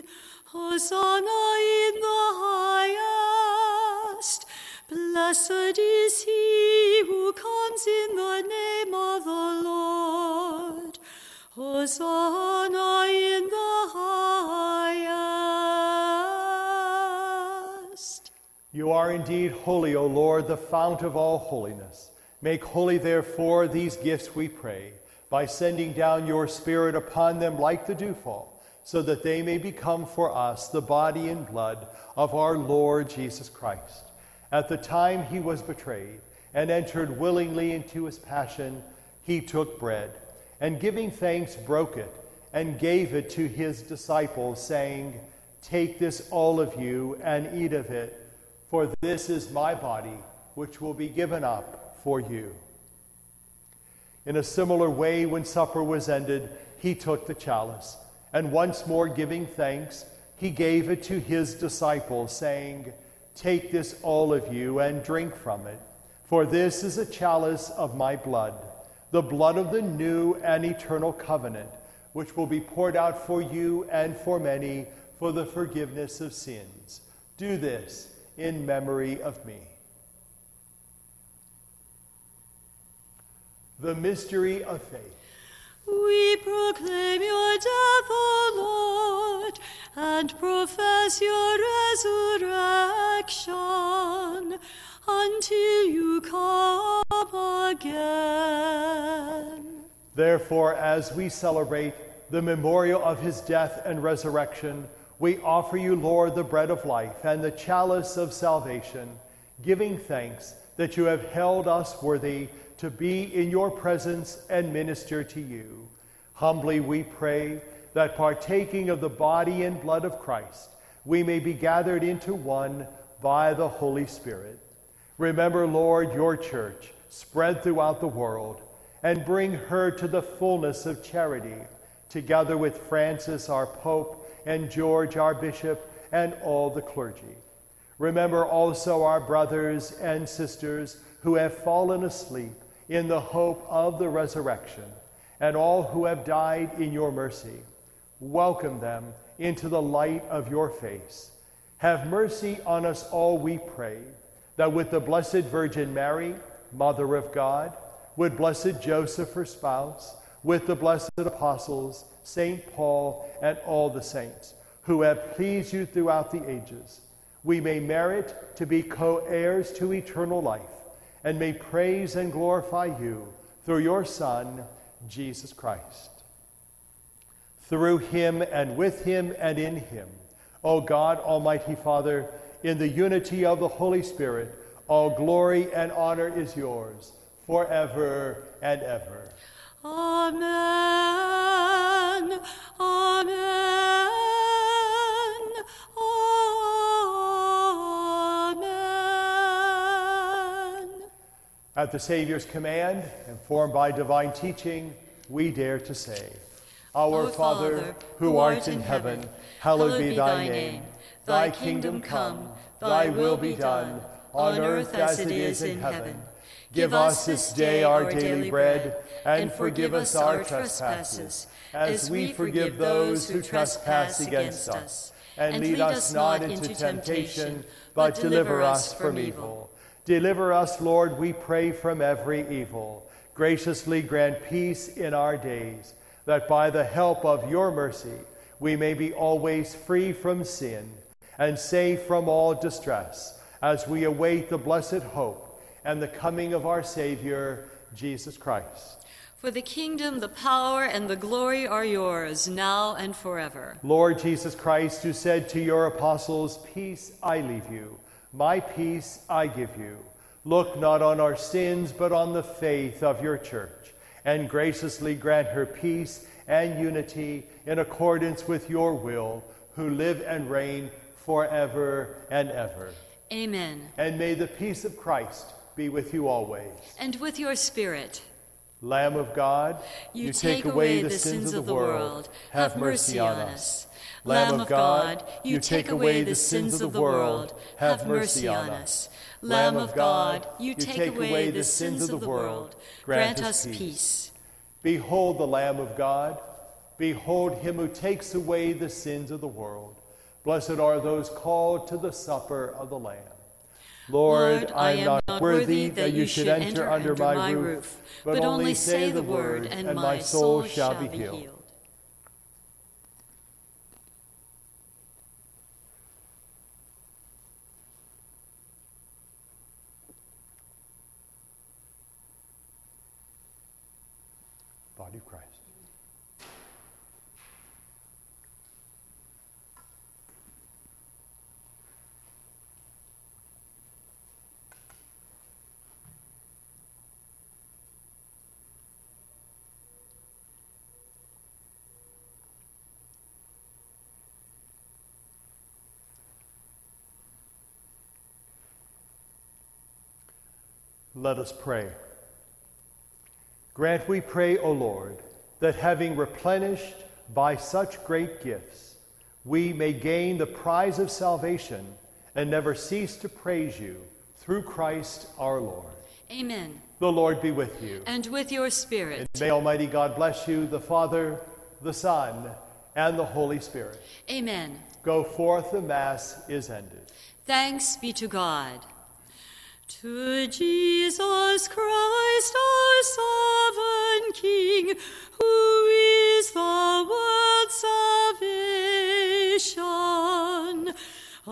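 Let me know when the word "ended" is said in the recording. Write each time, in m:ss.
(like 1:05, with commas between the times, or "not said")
0:56, 6:16.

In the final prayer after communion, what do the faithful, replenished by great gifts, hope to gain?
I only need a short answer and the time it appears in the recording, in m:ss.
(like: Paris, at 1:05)
The prize of salvation, at 6:00.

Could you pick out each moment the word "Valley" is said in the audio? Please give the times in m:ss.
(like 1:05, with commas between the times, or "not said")
not said.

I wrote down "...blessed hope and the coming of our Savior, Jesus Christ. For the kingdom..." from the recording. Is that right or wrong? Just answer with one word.
right.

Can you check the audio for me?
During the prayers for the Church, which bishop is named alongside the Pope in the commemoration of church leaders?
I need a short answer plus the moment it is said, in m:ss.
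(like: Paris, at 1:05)
George, at 2:14.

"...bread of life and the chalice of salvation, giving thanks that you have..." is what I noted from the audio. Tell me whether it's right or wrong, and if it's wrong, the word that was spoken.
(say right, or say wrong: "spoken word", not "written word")
right.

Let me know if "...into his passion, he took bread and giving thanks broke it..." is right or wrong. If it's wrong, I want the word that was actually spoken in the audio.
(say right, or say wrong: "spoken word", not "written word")
right.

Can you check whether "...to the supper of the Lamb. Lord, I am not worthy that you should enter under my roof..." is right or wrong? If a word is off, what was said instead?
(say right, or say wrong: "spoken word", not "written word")
right.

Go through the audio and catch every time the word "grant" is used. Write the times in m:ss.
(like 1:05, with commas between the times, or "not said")
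3:53, 4:25, 4:53, 5:53.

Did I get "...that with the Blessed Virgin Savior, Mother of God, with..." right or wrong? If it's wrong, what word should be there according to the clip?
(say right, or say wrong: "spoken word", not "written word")
wrong: "Mary", not "Savior".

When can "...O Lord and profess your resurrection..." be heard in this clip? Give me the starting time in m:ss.
1:28.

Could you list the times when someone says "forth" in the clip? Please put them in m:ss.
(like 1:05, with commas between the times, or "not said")
6:15.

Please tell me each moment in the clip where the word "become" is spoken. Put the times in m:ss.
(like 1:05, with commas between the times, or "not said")
0:29.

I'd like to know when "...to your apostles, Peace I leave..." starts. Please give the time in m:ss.
4:15.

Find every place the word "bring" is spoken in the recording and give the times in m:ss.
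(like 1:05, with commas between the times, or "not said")
2:09.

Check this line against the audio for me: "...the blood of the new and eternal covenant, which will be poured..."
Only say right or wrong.
right.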